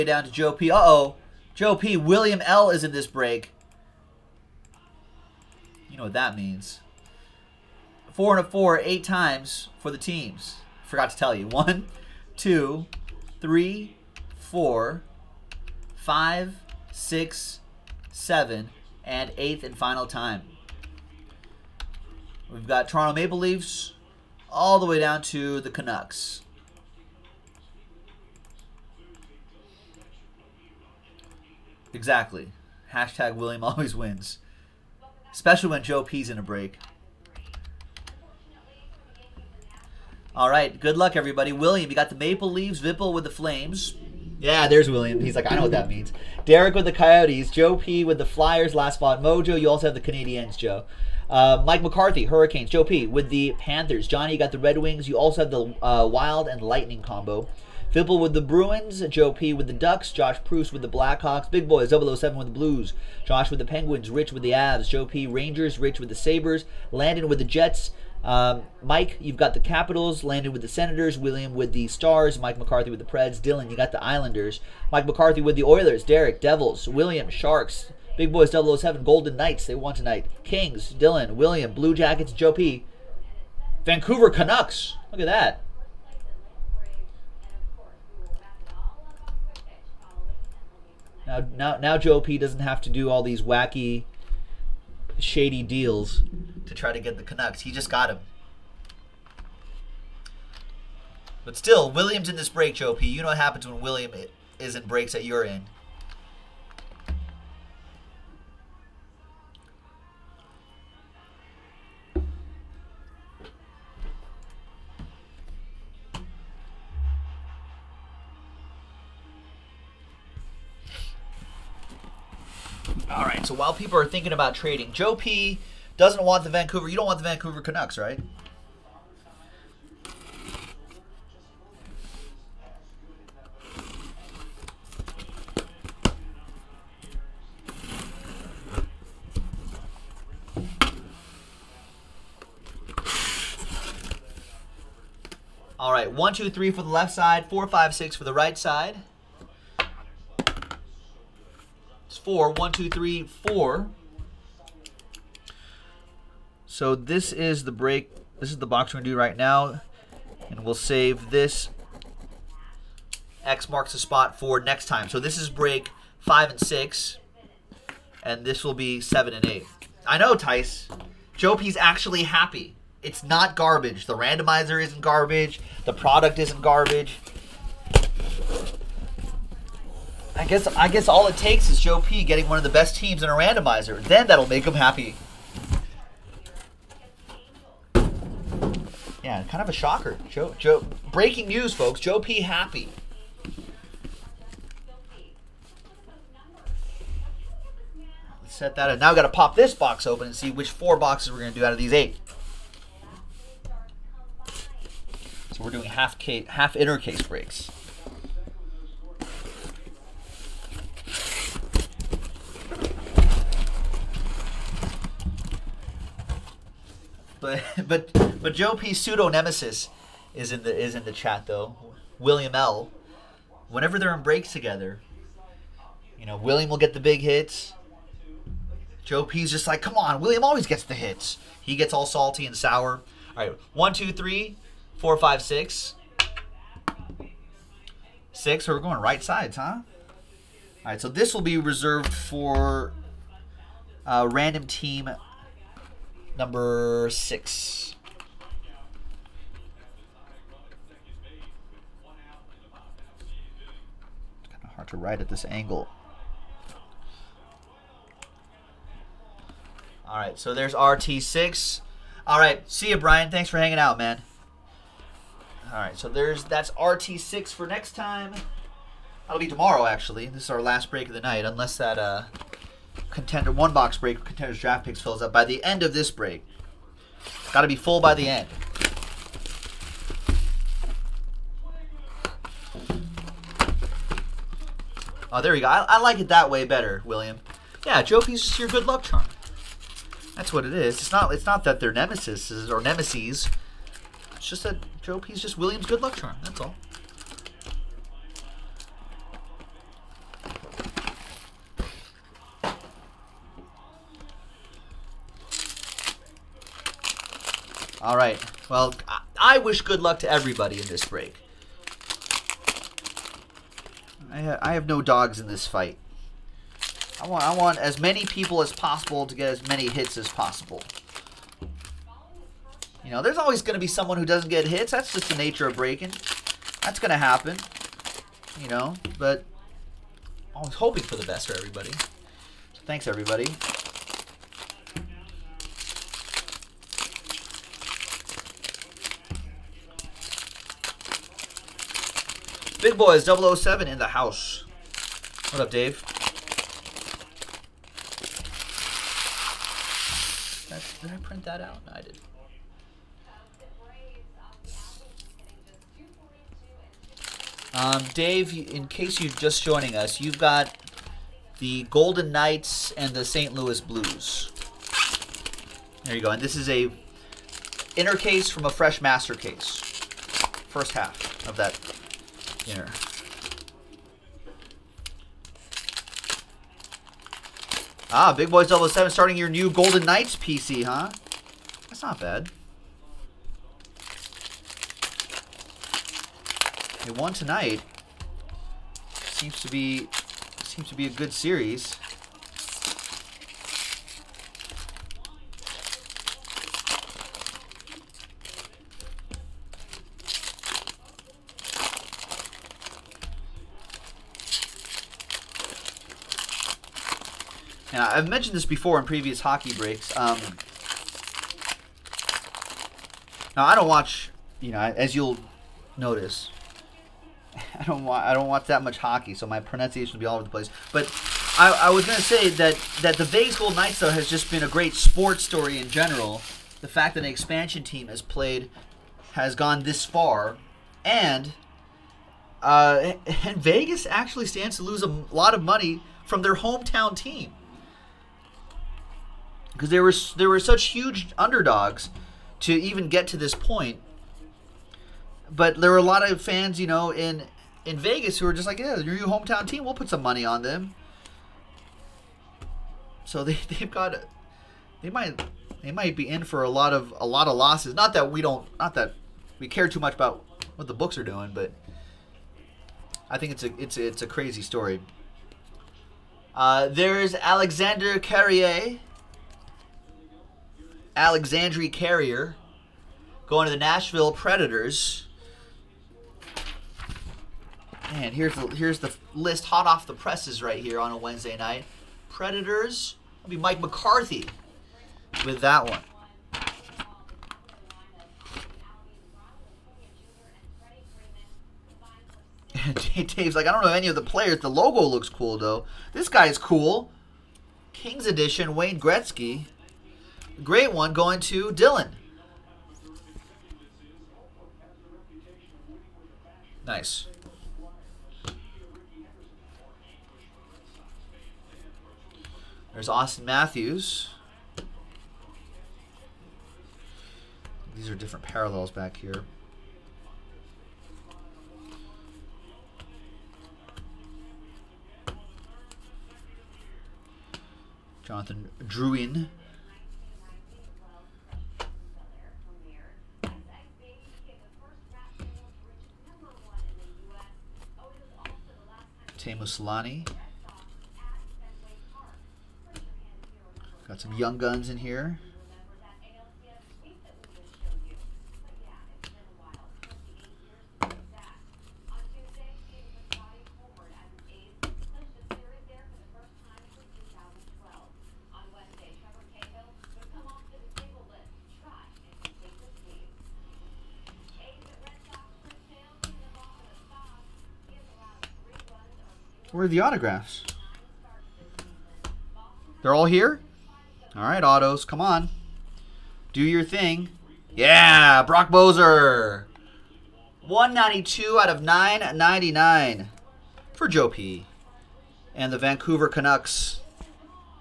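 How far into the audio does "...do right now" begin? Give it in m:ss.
2:39.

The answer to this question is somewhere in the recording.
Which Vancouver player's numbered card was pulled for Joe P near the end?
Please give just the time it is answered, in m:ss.
9:38.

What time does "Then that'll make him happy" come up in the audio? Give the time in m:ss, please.
3:04.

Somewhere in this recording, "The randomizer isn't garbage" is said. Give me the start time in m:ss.
2:54.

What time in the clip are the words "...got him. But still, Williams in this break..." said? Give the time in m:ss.
1:37.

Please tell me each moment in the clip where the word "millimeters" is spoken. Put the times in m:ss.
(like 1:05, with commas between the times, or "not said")
not said.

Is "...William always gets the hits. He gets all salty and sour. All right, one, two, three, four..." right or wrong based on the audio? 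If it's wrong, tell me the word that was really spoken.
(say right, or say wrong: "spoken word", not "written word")
right.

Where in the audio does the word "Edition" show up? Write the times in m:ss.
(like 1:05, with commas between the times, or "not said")
8:18.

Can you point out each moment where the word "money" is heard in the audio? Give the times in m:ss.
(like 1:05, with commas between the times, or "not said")
7:15, 7:30.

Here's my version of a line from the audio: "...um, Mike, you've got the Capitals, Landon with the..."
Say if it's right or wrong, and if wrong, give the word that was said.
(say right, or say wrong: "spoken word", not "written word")
right.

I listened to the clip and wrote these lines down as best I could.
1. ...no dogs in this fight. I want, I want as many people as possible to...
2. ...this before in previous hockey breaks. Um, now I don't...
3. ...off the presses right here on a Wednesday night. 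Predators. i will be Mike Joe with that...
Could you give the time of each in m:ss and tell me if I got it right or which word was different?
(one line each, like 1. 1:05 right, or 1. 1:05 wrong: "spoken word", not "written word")
1. 5:14 right
2. 6:48 right
3. 7:59 wrong: "McCarthy", not "Joe".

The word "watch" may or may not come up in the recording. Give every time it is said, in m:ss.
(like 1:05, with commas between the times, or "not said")
6:53, 6:58.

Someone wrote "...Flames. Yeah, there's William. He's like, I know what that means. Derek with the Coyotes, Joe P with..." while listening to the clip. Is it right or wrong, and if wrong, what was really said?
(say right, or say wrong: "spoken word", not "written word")
right.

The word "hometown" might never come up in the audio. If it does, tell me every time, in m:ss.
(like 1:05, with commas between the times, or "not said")
7:16, 7:29.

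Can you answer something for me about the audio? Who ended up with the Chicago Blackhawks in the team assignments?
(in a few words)
Josh Proust.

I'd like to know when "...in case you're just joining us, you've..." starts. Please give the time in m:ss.
5:58.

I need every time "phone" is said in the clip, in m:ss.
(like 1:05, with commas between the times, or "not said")
not said.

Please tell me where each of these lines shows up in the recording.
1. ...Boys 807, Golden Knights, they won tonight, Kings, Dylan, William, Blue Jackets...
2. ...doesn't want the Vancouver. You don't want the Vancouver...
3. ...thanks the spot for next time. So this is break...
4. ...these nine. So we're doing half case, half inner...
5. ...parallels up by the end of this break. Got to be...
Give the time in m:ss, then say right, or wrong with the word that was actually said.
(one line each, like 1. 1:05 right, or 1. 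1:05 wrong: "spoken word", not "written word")
1. 1:18 wrong: "007", not "807"
2. 2:05 right
3. 2:43 wrong: "marks", not "thanks"
4. 3:21 wrong: "eight", not "nine"
5. 4:35 wrong: "fills", not "parallels".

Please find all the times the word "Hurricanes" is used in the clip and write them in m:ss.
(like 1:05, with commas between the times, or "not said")
0:52.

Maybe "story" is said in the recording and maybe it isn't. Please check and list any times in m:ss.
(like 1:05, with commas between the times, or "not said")
7:05, 7:44.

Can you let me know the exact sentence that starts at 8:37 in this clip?
These are different parallels back here.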